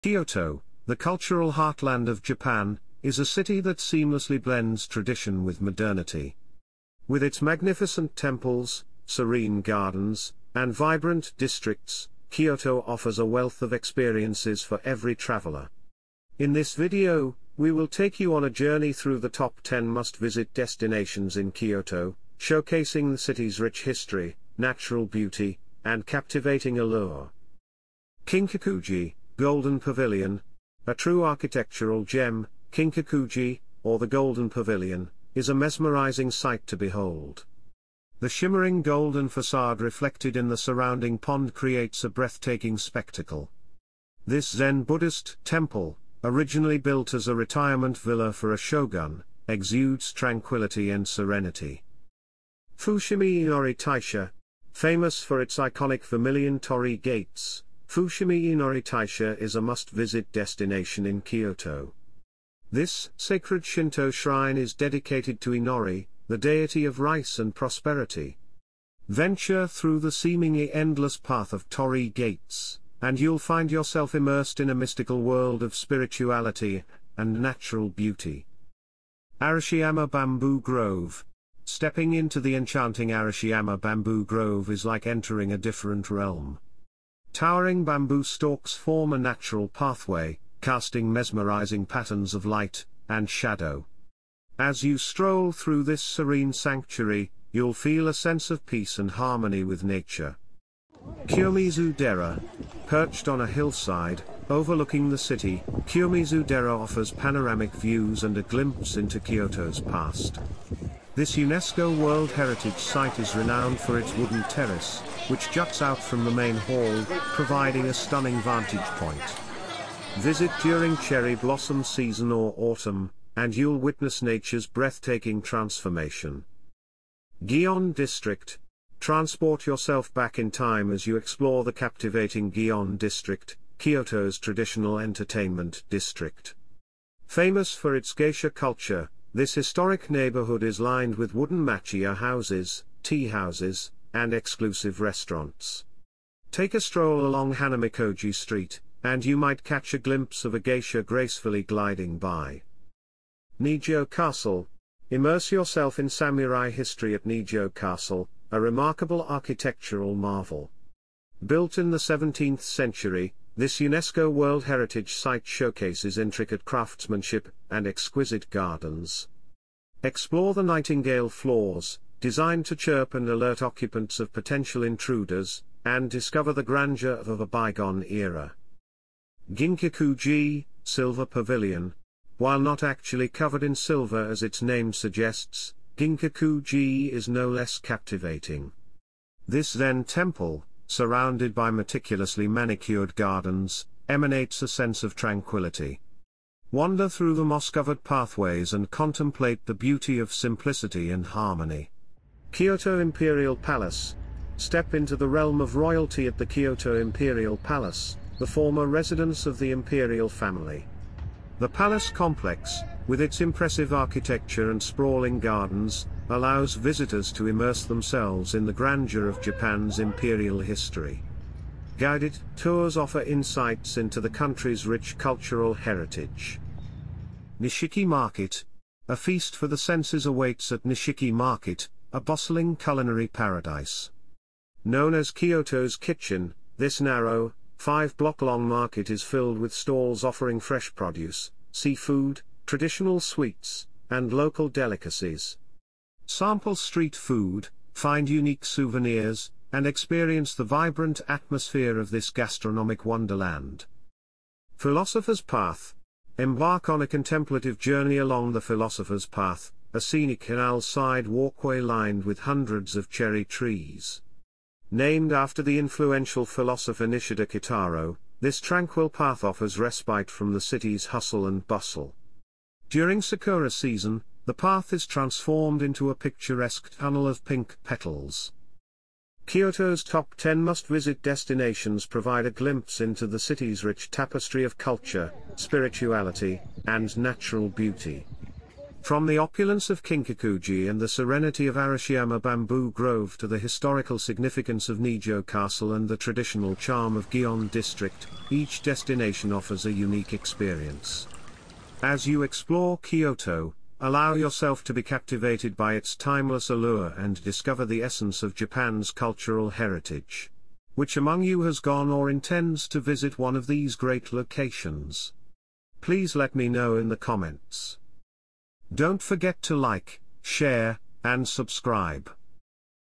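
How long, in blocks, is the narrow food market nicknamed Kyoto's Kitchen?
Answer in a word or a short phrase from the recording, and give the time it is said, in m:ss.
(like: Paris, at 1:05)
5 blocks, at 3:57.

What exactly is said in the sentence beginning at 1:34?
As you stroll through this serene sanctuary, you'll feel a sense of peace and harmony with nature.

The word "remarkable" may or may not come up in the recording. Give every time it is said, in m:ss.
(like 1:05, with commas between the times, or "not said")
2:38.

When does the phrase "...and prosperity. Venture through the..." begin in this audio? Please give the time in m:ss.
1:07.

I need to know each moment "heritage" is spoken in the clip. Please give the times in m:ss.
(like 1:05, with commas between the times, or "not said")
1:52, 2:44, 3:45, 5:09.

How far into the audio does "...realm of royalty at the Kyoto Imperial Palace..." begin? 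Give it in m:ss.
3:25.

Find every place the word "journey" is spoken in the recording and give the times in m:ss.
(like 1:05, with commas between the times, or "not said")
0:18, 4:17.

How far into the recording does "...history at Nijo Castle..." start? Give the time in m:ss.
2:36.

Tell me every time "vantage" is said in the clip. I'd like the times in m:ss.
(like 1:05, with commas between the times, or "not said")
1:58.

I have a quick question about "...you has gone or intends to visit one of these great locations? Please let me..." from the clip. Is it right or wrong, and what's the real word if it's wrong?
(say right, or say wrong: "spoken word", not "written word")
right.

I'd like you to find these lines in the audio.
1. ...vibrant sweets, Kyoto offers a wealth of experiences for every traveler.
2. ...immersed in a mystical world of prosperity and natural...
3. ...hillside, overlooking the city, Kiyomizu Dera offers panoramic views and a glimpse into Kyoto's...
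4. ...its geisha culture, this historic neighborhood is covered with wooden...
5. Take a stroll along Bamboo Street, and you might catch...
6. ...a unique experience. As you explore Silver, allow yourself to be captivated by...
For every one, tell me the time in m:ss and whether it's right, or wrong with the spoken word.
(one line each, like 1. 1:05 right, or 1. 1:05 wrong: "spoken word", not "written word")
1. 0:10 wrong: "districts", not "sweets"
2. 1:14 wrong: "spirituality", not "prosperity"
3. 1:43 right
4. 2:17 wrong: "lined", not "covered"
5. 2:26 wrong: "Hanamikoji", not "Bamboo"
6. 4:59 wrong: "Kyoto", not "Silver".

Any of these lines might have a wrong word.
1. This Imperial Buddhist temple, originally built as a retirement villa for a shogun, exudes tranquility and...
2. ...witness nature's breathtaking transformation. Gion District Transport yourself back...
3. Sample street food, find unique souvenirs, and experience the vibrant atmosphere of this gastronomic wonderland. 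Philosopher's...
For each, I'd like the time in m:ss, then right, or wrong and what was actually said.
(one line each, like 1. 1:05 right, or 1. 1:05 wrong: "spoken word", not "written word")
1. 0:44 wrong: "Zen", not "Imperial"
2. 2:03 right
3. 4:06 right.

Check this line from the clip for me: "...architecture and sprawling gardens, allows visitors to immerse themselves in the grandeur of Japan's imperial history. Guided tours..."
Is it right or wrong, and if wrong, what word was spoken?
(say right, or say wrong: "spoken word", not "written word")
right.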